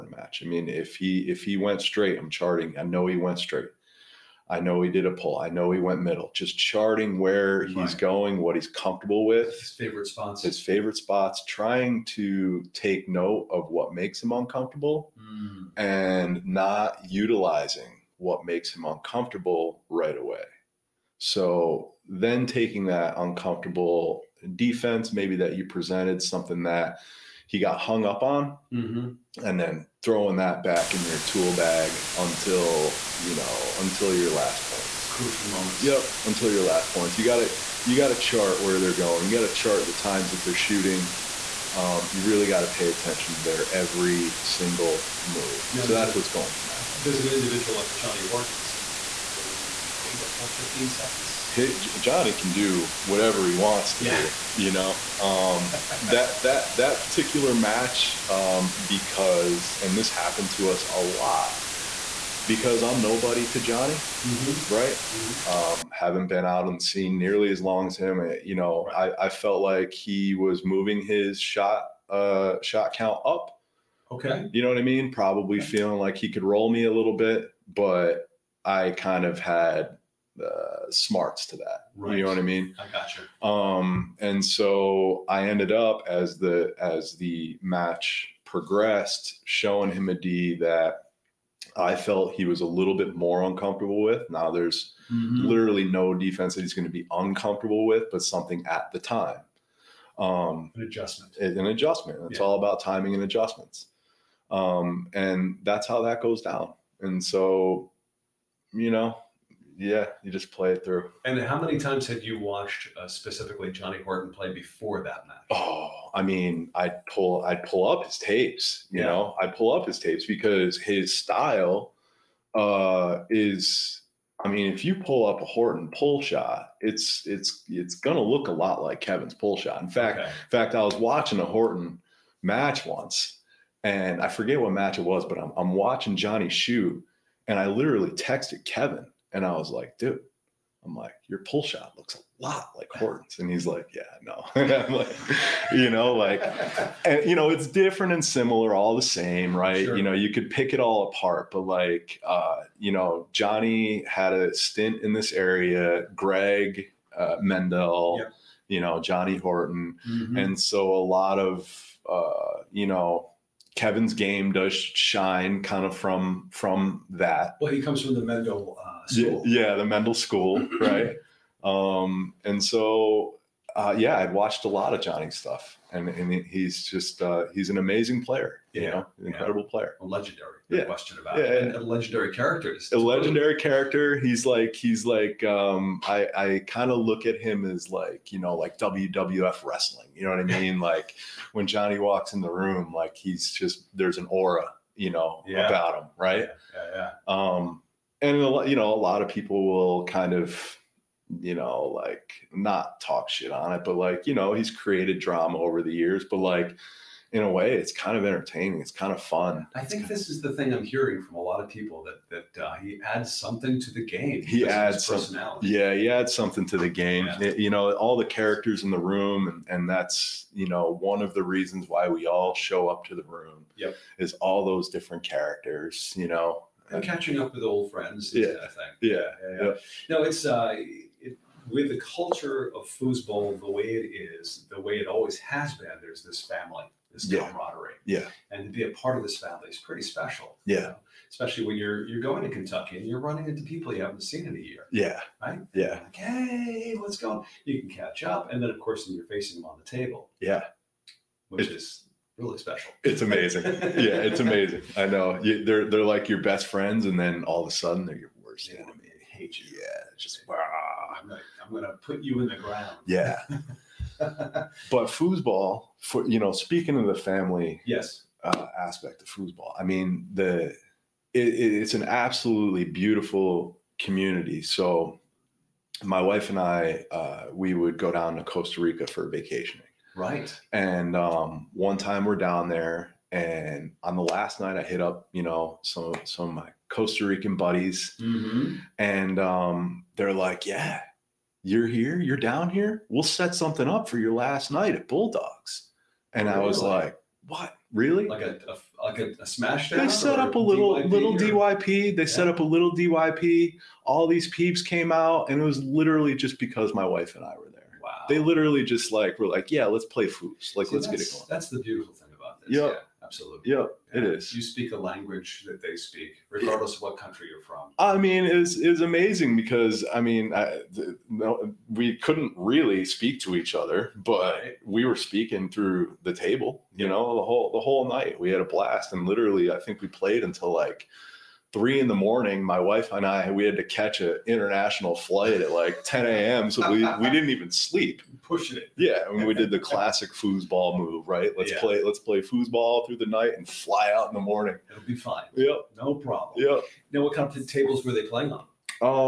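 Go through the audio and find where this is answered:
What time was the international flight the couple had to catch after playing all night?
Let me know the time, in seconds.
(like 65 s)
336 s.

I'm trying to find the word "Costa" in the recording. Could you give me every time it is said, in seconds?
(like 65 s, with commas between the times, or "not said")
278 s, 286 s.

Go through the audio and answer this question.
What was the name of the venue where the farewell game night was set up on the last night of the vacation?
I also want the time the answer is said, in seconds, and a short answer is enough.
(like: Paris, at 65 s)
Bulldogs, at 295 s.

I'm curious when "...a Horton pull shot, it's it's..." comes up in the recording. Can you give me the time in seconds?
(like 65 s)
125 s.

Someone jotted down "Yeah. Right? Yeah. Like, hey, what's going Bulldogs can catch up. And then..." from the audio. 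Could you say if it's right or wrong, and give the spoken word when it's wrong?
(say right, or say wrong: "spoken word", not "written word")
wrong: "You", not "Bulldogs".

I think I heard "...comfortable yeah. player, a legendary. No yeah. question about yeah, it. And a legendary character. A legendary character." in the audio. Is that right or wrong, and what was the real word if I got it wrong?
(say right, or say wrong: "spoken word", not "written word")
wrong: "incredible", not "comfortable".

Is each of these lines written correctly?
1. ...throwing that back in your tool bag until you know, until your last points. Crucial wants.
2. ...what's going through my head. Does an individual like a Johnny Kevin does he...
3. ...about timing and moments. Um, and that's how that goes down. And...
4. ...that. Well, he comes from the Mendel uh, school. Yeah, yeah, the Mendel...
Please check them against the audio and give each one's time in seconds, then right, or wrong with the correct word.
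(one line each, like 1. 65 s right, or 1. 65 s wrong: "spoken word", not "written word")
1. 30 s wrong: "moments", not "wants"
2. 46 s wrong: "Horton", not "Kevin"
3. 102 s wrong: "adjustments", not "moments"
4. 167 s right.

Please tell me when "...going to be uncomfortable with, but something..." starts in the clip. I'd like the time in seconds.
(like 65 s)
96 s.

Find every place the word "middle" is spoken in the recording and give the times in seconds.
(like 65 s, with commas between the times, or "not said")
6 s.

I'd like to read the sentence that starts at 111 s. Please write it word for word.
And how many times had you watched uh, specifically Johnny Horton play before that match?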